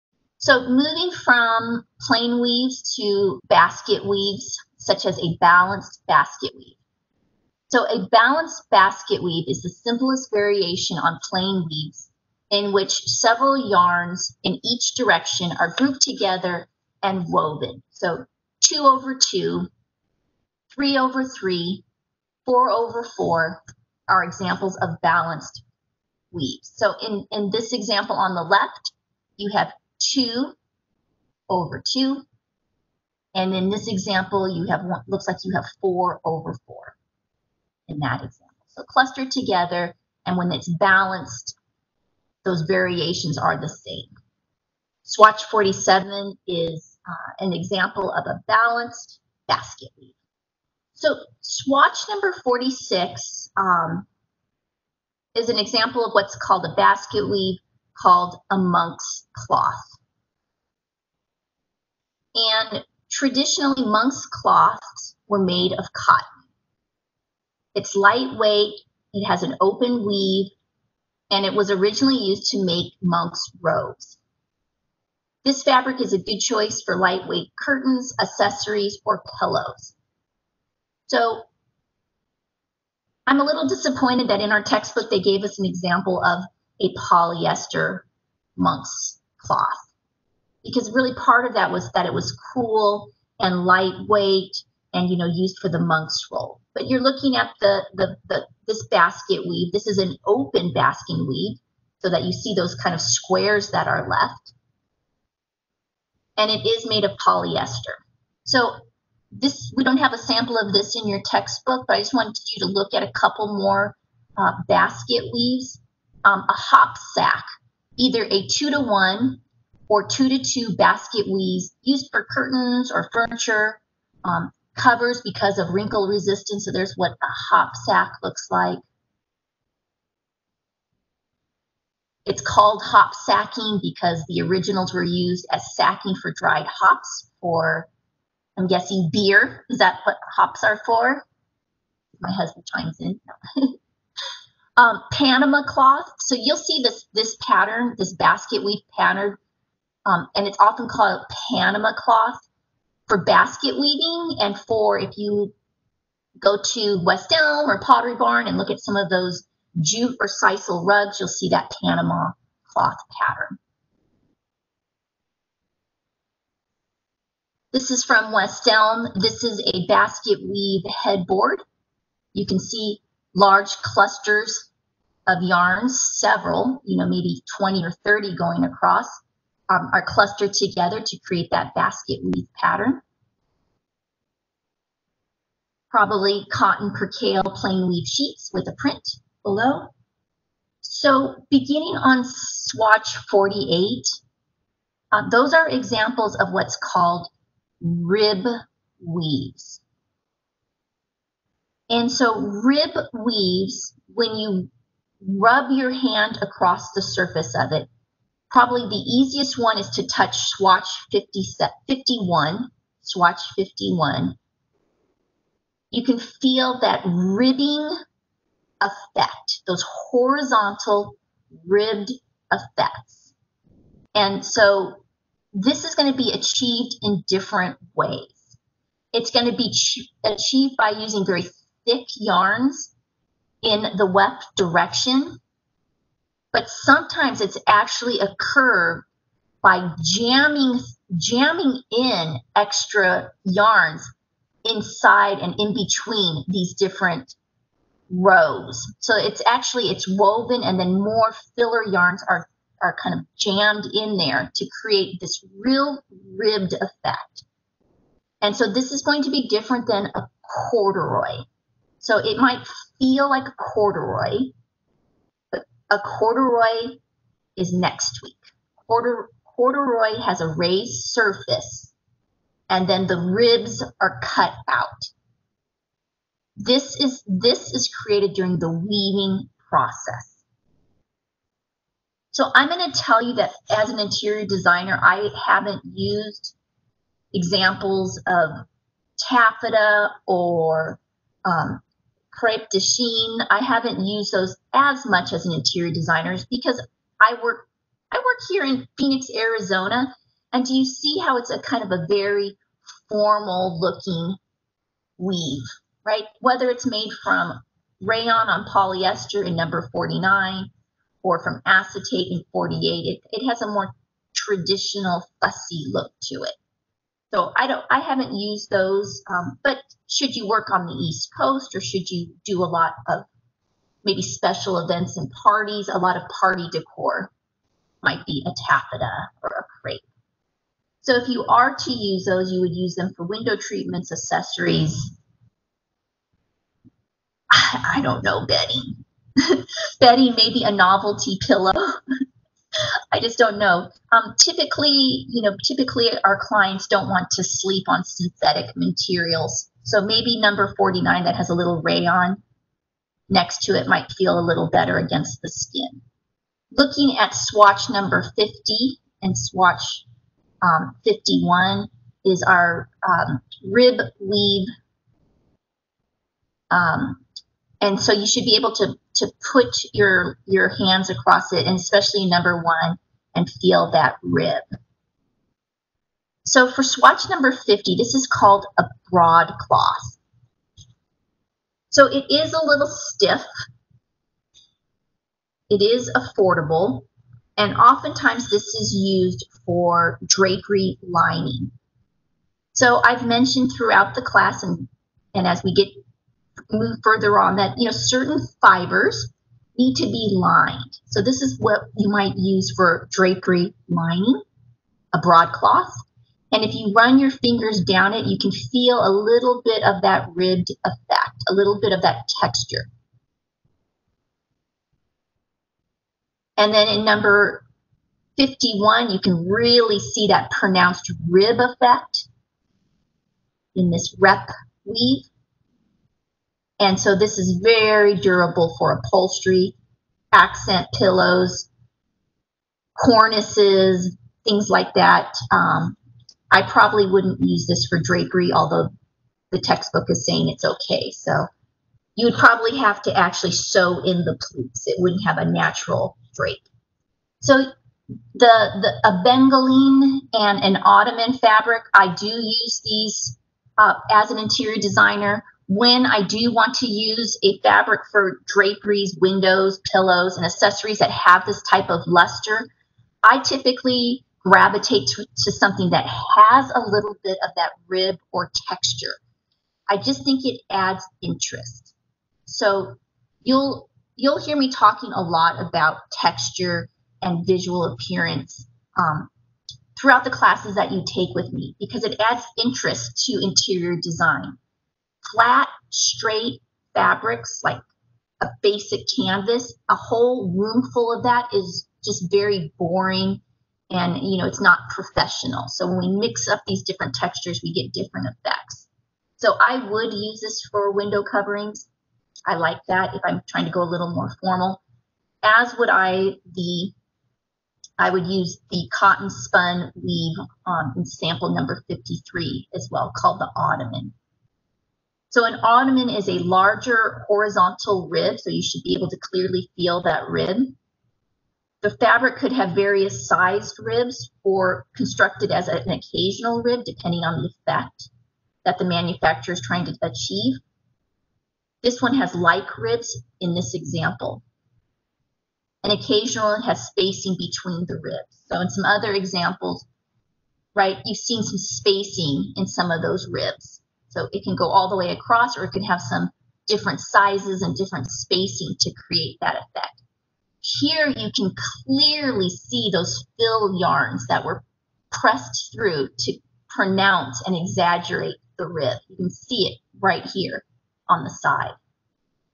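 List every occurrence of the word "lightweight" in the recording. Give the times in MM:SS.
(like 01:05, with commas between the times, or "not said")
01:07, 01:16, 01:33.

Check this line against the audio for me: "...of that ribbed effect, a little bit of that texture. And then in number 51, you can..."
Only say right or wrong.
right.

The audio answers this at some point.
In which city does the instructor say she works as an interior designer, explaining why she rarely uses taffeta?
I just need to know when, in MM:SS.
04:58.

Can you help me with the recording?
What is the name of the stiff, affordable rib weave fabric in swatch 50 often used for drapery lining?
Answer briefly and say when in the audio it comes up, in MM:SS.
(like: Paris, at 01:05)
Broadcloth, at 06:19.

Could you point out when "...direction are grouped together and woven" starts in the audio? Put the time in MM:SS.
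00:14.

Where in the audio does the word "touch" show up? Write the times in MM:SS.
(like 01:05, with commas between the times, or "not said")
03:30.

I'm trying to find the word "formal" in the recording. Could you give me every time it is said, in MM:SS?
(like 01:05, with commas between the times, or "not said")
05:03, 08:24.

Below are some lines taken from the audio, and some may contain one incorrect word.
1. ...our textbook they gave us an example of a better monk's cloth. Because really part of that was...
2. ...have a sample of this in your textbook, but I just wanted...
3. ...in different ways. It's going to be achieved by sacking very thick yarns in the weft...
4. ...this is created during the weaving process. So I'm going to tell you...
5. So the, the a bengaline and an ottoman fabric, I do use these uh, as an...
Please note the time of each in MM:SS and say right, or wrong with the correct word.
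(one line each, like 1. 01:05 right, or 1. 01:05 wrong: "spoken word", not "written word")
1. 01:24 wrong: "polyester", not "better"
2. 01:49 right
3. 03:47 wrong: "using", not "sacking"
4. 04:37 right
5. 07:27 right.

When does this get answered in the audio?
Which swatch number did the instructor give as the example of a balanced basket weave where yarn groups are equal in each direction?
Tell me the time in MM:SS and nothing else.
00:45.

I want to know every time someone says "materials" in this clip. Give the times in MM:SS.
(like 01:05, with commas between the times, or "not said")
05:48.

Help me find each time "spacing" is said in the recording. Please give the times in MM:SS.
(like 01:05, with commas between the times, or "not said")
08:56, 09:01, 09:08.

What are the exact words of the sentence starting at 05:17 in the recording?
So I don't, I haven't used those.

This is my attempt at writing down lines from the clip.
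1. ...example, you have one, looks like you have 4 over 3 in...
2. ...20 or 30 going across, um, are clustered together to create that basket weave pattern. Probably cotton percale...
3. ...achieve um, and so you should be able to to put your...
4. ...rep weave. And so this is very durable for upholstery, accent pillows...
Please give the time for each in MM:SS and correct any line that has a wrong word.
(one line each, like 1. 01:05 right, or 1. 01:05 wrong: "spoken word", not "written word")
1. 00:33 wrong: "4", not "3"
2. 02:57 right
3. 06:04 wrong: "weave", not "achieve"
4. 07:04 right.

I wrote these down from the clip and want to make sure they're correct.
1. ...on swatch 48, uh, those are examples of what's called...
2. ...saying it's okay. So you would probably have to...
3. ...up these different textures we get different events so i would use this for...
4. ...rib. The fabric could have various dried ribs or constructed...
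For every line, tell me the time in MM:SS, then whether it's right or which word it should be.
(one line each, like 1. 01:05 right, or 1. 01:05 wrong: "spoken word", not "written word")
1. 03:11 right
2. 07:20 right
3. 08:16 wrong: "effects", not "events"
4. 08:40 wrong: "sized", not "dried".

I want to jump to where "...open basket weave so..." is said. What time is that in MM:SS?
01:40.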